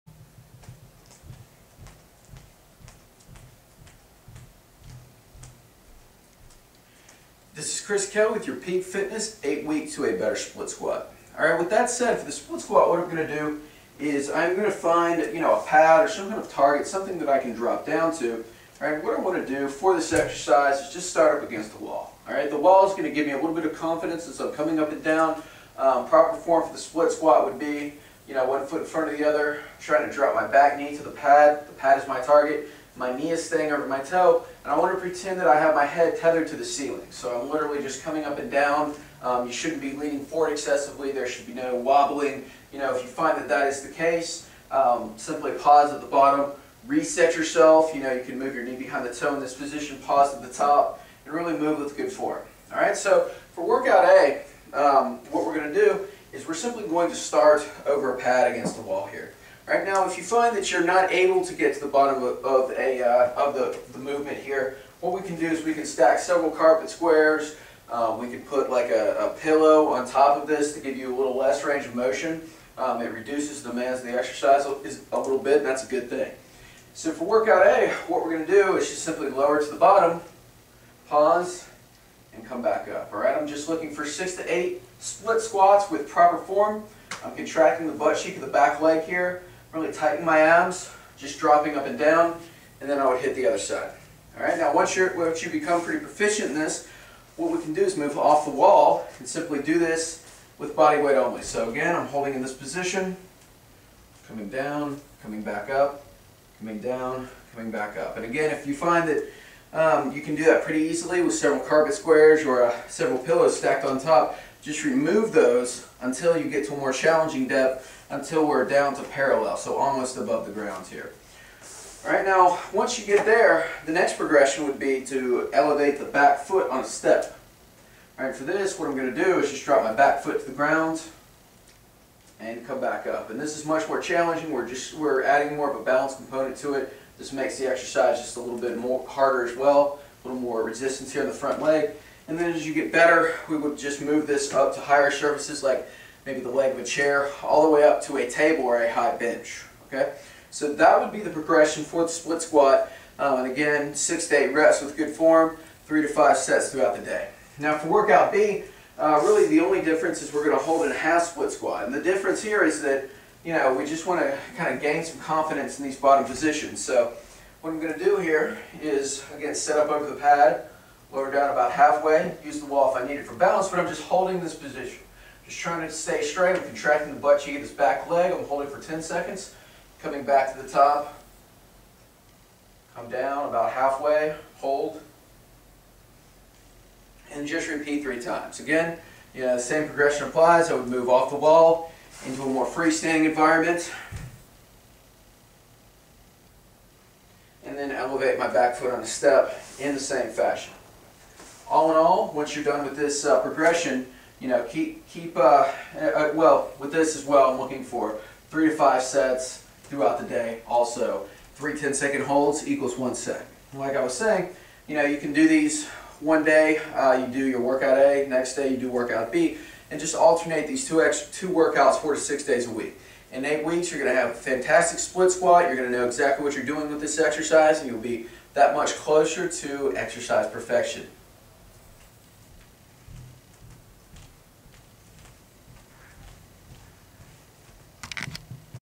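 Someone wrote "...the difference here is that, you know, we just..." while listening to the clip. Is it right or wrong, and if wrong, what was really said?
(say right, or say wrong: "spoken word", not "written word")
right.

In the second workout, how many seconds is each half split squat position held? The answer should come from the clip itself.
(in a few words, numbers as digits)
10.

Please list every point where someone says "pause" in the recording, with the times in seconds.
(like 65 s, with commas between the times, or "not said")
45 s, 50 s, 81 s.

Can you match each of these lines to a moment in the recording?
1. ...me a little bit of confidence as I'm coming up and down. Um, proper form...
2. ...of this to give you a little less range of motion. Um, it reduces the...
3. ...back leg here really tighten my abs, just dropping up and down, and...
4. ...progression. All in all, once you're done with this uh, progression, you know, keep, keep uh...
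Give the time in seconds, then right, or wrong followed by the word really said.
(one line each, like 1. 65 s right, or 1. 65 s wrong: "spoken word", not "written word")
1. 23 s right
2. 70 s right
3. 88 s right
4. 200 s wrong: "fashion", not "progression".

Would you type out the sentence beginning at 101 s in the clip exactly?
So again, I'm holding in this position, coming down, coming back up, coming down, coming back up.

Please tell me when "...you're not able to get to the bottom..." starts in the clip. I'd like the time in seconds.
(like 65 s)
60 s.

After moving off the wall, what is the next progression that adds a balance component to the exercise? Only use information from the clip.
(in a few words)
elevate the back foot on a step.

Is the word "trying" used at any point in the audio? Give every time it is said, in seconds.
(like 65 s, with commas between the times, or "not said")
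29 s, 175 s.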